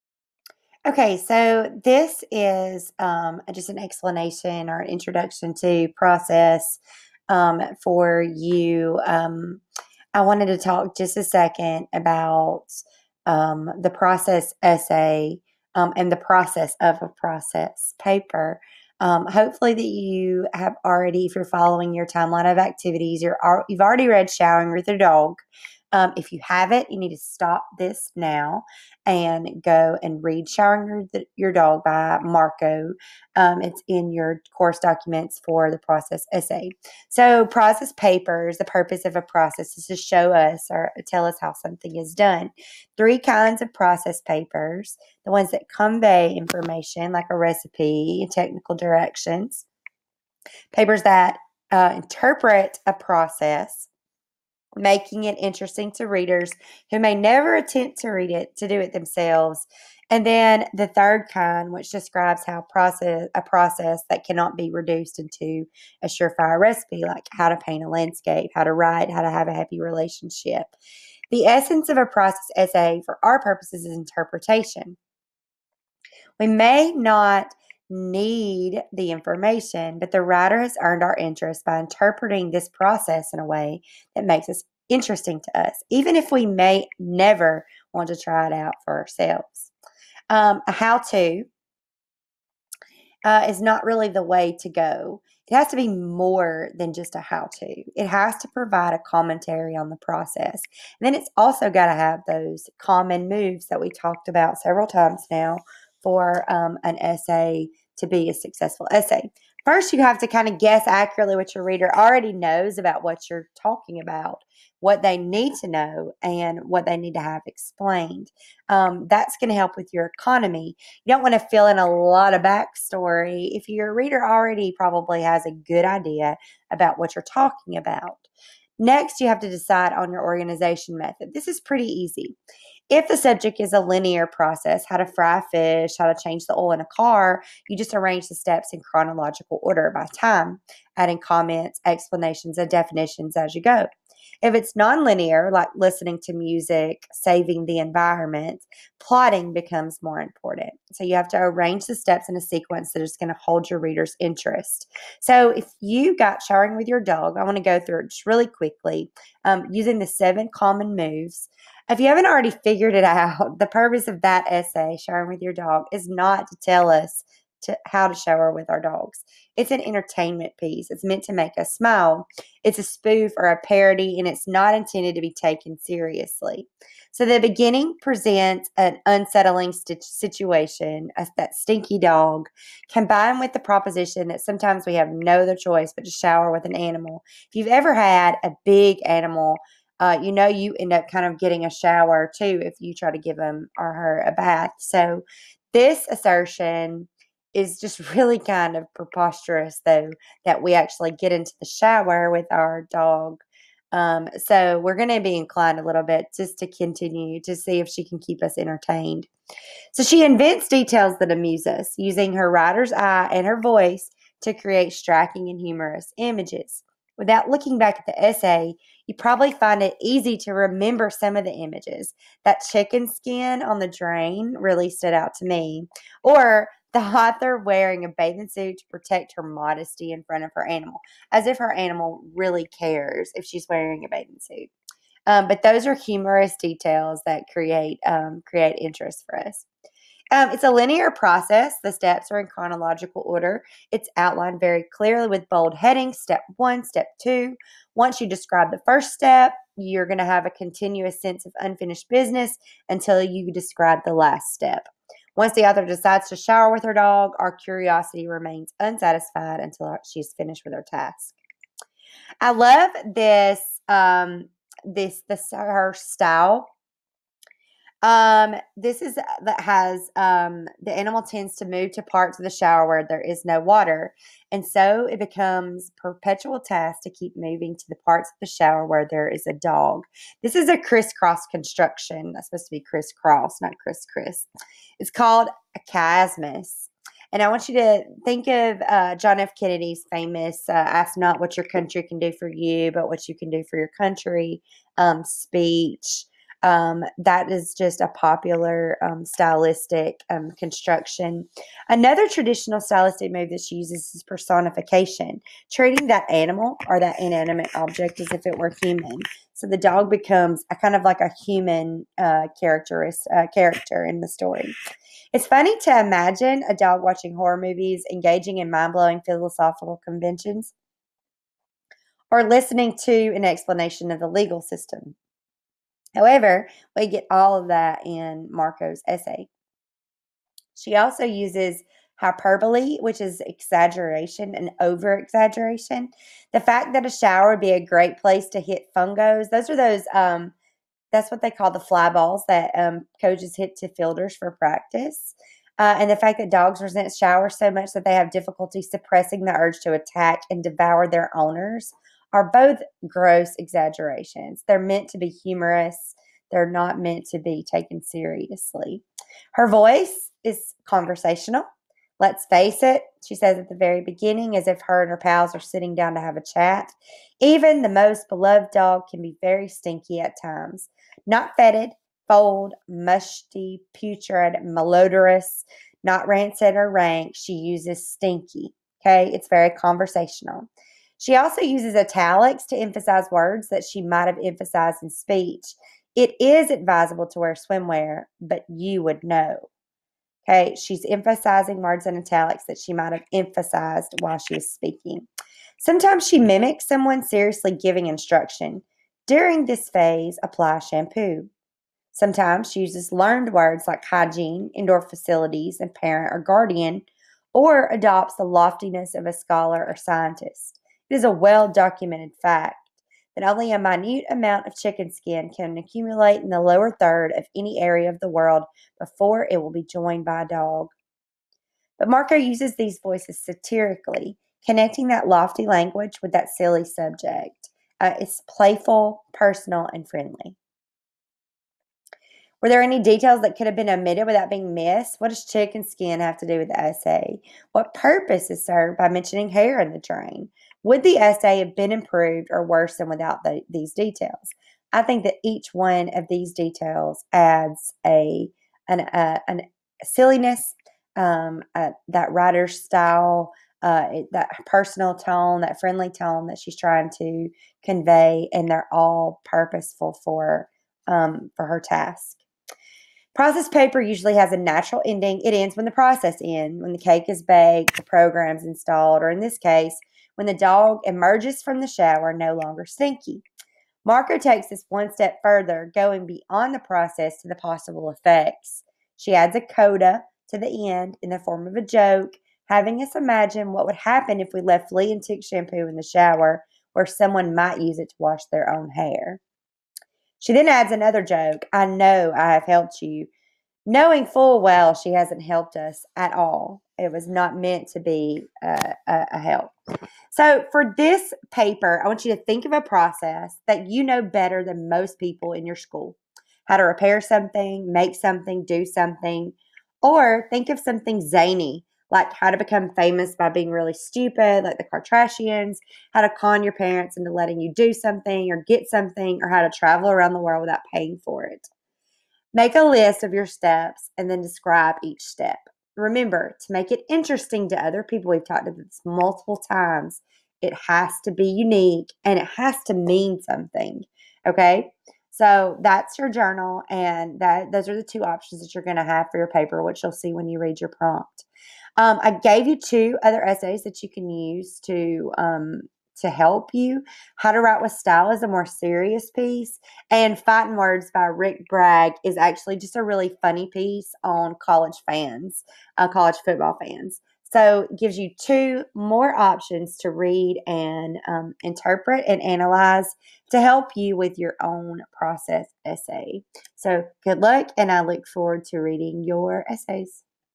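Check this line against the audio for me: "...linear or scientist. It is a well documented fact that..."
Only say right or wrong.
wrong.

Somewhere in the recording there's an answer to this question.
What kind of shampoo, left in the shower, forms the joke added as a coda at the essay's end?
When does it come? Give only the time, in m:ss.
8:04.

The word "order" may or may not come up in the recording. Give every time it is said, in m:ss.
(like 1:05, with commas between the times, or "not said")
2:19, 4:03.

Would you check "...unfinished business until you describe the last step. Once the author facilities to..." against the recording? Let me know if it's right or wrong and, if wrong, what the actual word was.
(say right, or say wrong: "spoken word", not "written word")
wrong: "decides", not "facilities".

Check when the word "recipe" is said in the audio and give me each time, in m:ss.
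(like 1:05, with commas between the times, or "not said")
0:47, 1:06.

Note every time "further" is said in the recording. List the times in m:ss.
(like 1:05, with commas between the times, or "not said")
7:55.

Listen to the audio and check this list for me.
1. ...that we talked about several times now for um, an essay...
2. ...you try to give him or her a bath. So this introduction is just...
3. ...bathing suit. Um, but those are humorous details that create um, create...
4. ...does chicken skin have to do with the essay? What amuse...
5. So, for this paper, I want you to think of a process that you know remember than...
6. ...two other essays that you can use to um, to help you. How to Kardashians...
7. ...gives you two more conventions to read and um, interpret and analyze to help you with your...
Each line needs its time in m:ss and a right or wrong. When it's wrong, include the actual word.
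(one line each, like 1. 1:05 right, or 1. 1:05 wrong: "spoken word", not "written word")
1. 1:43 right
2. 3:12 wrong: "assertion", not "introduction"
3. 3:54 right
4. 7:15 wrong: "purpose", not "amuse"
5. 8:20 wrong: "better", not "remember"
6. 9:02 wrong: "Write", not "Kardashians"
7. 9:17 wrong: "options", not "conventions".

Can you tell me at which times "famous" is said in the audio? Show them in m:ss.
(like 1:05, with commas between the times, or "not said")
4:50, 8:32.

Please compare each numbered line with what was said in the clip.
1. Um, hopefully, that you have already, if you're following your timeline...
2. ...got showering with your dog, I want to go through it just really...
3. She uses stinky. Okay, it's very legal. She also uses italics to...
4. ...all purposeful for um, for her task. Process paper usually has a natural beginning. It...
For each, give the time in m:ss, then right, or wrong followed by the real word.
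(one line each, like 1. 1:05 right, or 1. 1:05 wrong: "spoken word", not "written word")
1. 0:18 right
2. 2:36 right
3. 6:17 wrong: "conversational", not "legal"
4. 7:38 wrong: "ending", not "beginning".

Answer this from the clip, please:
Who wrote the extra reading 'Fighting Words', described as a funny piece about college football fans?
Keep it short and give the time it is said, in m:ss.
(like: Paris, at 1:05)
Rick Bragg, at 9:11.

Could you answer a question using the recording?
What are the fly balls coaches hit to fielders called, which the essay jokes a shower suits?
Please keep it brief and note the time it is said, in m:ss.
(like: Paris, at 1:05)
fungos, at 5:38.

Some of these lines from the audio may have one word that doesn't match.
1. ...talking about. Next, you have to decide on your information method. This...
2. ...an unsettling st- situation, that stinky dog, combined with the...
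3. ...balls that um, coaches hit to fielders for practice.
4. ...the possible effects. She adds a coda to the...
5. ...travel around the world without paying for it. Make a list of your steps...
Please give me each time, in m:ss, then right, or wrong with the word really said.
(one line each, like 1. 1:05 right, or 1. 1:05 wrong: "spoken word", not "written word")
1. 2:07 wrong: "organization", not "information"
2. 2:58 right
3. 5:42 right
4. 7:57 right
5. 8:39 right.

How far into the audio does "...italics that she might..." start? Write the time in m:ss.
6:32.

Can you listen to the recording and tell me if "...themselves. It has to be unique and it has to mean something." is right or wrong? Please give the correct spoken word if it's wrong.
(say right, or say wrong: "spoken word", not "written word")
wrong: "times", not "themselves".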